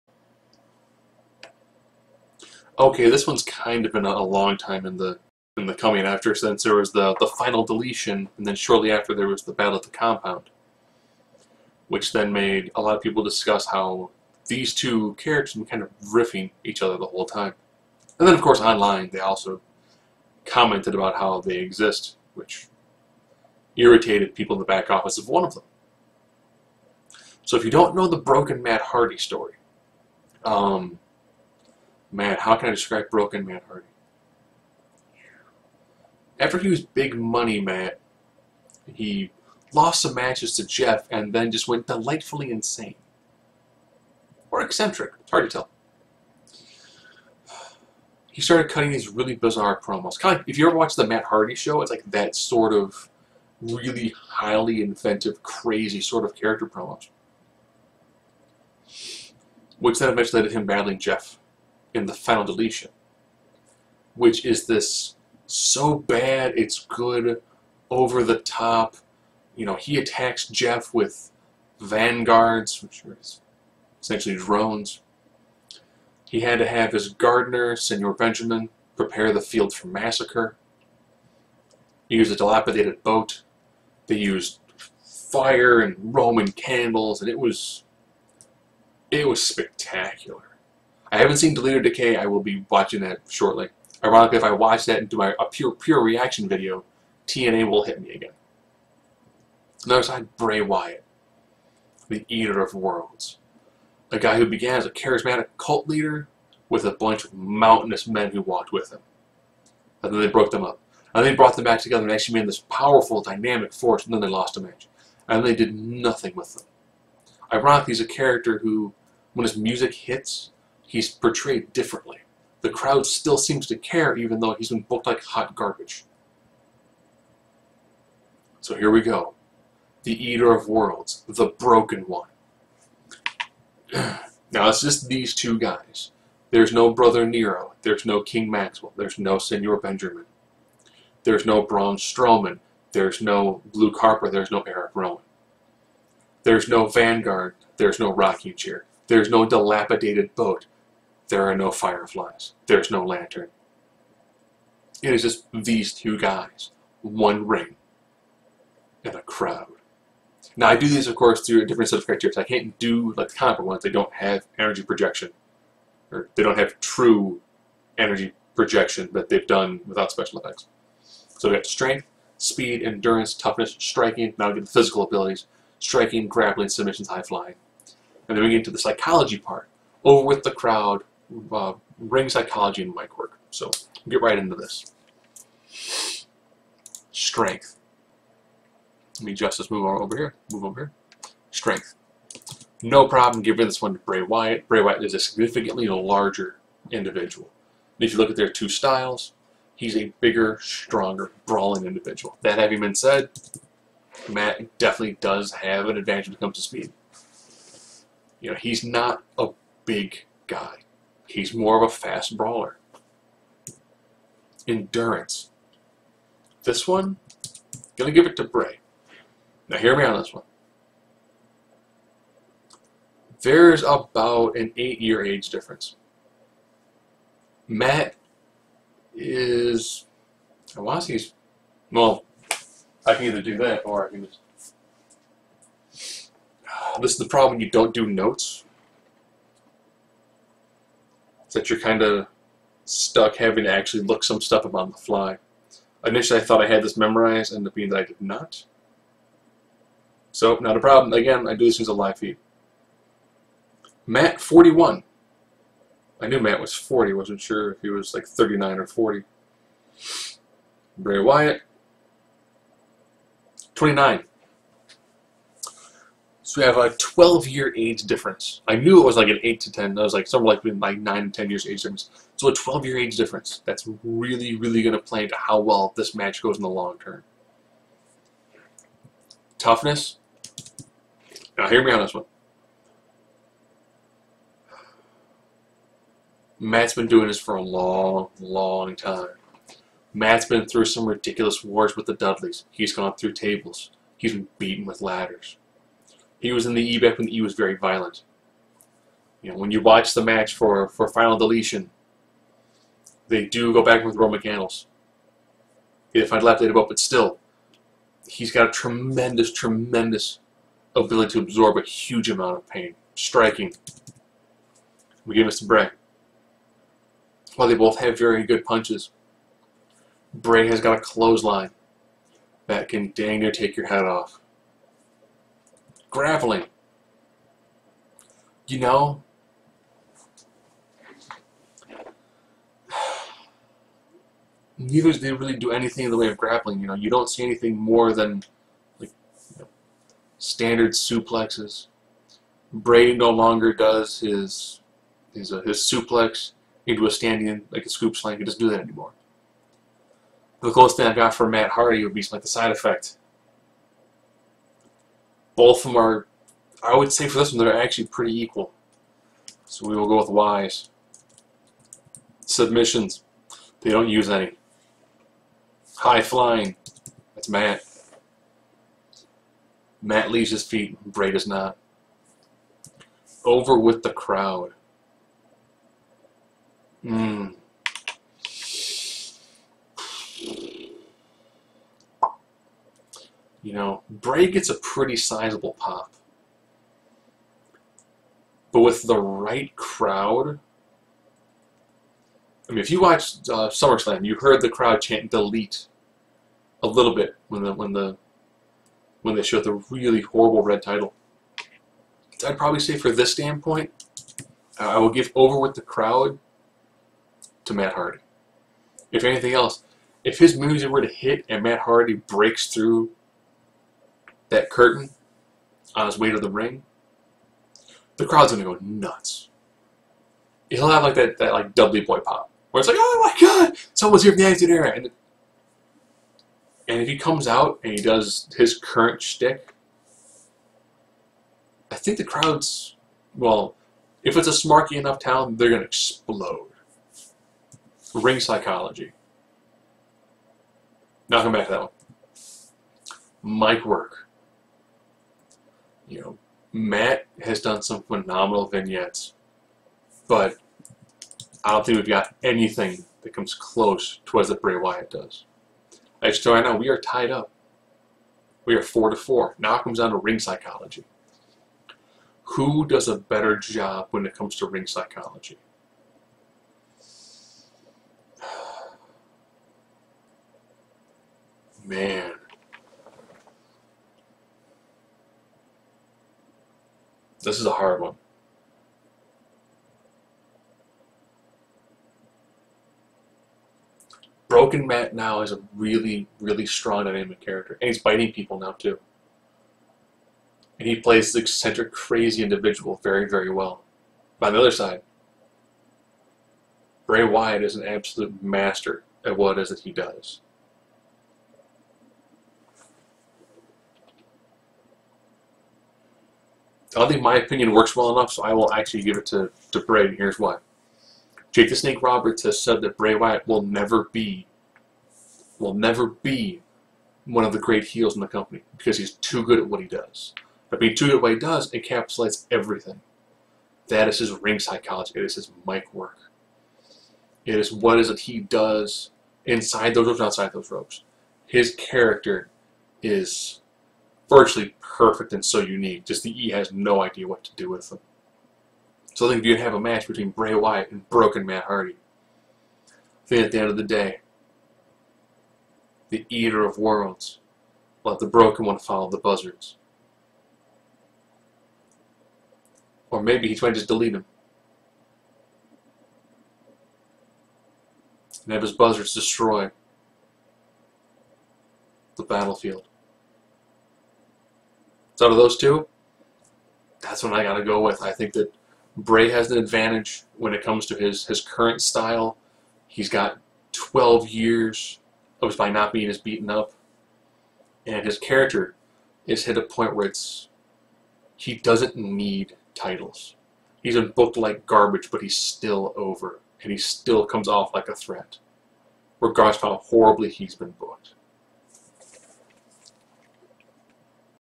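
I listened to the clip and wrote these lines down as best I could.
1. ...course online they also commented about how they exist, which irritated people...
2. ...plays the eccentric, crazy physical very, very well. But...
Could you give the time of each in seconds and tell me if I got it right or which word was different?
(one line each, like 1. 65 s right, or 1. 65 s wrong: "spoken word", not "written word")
1. 18 s right
2. 490 s wrong: "individual", not "physical".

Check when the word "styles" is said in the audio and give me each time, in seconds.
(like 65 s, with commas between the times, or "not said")
198 s, 571 s.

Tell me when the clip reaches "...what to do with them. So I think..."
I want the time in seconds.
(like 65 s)
537 s.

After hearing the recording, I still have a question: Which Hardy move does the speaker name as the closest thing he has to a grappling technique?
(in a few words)
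the side effect.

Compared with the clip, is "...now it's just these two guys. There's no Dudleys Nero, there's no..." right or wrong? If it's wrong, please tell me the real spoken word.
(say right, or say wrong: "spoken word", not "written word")
wrong: "Brother", not "Dudleys".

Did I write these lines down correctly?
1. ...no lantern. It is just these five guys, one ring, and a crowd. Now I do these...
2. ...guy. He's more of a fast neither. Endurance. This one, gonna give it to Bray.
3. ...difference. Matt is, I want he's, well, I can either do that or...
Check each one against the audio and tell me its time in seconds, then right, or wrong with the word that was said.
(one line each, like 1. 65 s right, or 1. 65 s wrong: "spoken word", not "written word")
1. 152 s wrong: "two", not "five"
2. 210 s wrong: "brawler", not "neither"
3. 225 s right.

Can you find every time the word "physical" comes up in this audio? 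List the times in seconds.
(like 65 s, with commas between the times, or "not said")
174 s.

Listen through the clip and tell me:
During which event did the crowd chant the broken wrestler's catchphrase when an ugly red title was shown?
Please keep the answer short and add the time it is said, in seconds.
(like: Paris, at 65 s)
SummerSlam, at 393 s.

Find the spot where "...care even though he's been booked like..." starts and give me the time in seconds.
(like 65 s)
123 s.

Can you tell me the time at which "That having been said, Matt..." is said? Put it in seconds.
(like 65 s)
202 s.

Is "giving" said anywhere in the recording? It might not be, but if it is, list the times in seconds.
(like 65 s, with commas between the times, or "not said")
193 s.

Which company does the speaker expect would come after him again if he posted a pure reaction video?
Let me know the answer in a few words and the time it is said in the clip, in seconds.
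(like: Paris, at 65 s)
TNA, at 97 s.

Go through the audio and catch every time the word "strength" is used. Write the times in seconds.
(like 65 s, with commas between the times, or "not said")
171 s, 187 s, 191 s.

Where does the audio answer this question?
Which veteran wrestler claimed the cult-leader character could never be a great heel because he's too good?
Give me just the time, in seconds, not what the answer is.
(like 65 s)
511 s.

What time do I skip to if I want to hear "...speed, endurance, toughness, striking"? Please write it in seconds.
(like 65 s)
172 s.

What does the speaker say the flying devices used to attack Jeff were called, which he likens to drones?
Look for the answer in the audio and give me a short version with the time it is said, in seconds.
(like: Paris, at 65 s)
vanguards, at 71 s.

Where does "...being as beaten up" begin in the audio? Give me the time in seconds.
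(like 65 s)
575 s.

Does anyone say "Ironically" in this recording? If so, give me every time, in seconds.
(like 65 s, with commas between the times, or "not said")
94 s, 117 s.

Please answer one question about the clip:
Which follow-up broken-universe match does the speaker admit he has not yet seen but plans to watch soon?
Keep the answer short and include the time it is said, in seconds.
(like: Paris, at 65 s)
Deleted Decay, at 91 s.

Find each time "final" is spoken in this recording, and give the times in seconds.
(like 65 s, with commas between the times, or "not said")
7 s, 62 s, 301 s.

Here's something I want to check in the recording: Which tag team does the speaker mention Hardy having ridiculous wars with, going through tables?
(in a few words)
the Dudleys.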